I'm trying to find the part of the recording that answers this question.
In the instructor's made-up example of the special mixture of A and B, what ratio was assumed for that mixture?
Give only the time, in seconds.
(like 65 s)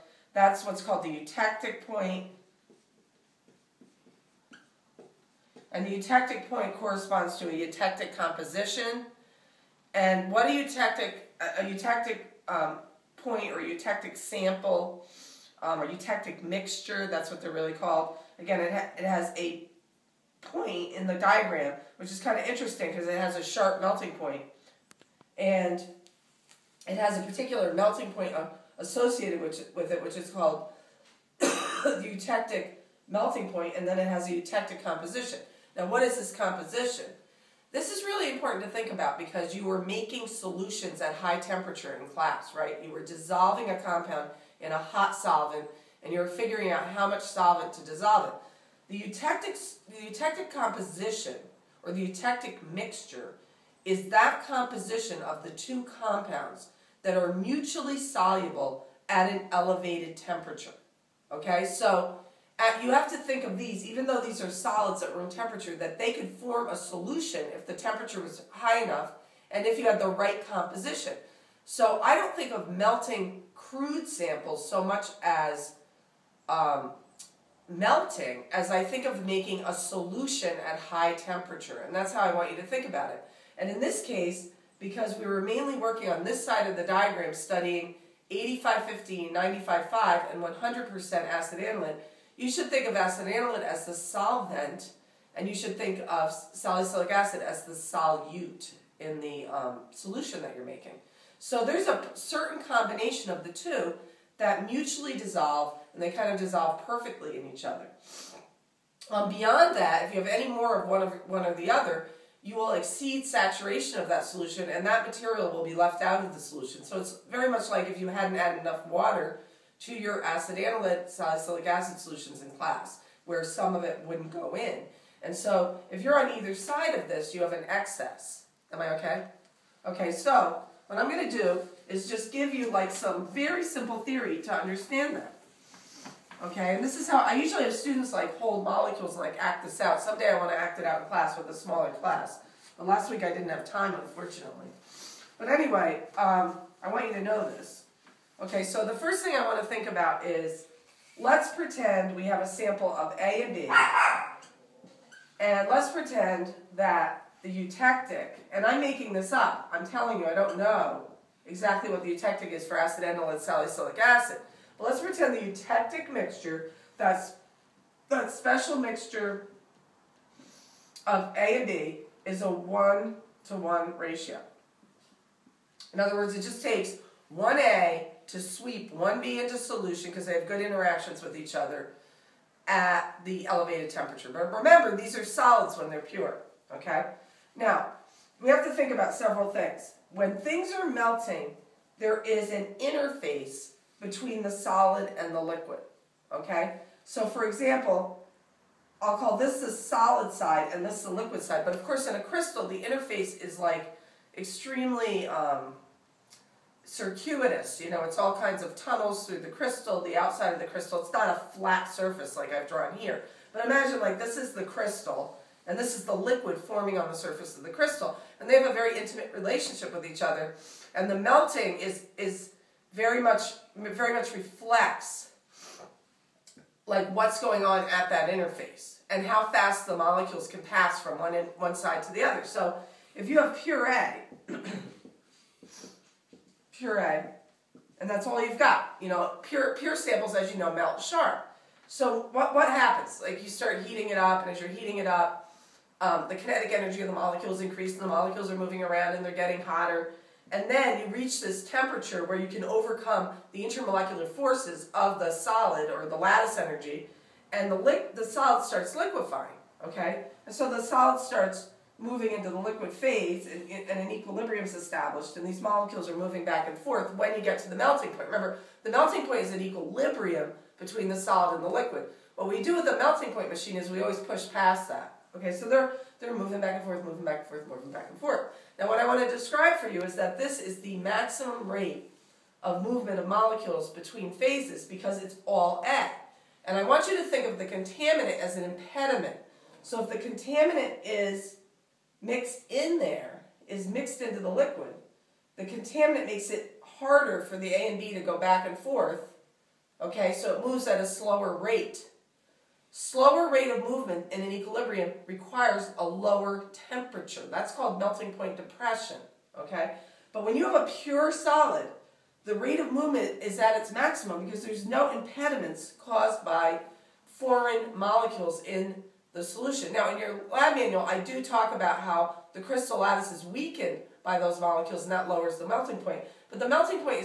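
172 s.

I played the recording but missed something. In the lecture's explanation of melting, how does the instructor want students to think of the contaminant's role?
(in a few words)
as an impediment.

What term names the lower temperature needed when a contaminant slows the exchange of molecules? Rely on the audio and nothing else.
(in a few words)
melting point depression.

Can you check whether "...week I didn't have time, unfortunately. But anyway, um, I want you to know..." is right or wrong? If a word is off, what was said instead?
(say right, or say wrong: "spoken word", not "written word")
right.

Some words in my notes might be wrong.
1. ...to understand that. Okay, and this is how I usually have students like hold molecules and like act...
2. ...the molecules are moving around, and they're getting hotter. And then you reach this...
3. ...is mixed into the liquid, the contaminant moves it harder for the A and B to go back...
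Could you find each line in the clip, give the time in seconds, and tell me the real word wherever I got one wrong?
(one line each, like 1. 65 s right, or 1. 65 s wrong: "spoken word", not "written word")
1. 134 s right
2. 248 s right
3. 293 s wrong: "makes", not "moves".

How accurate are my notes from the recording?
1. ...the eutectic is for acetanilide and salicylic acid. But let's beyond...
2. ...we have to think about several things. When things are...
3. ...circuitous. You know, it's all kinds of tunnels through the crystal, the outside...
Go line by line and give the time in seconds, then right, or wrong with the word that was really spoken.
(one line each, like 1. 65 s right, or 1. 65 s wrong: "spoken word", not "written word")
1. 162 s wrong: "pretend", not "beyond"
2. 188 s right
3. 206 s right.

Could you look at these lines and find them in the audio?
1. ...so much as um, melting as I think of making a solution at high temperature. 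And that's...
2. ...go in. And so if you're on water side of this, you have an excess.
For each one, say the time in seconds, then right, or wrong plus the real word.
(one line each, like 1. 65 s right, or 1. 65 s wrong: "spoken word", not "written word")
1. 74 s right
2. 124 s wrong: "either", not "water".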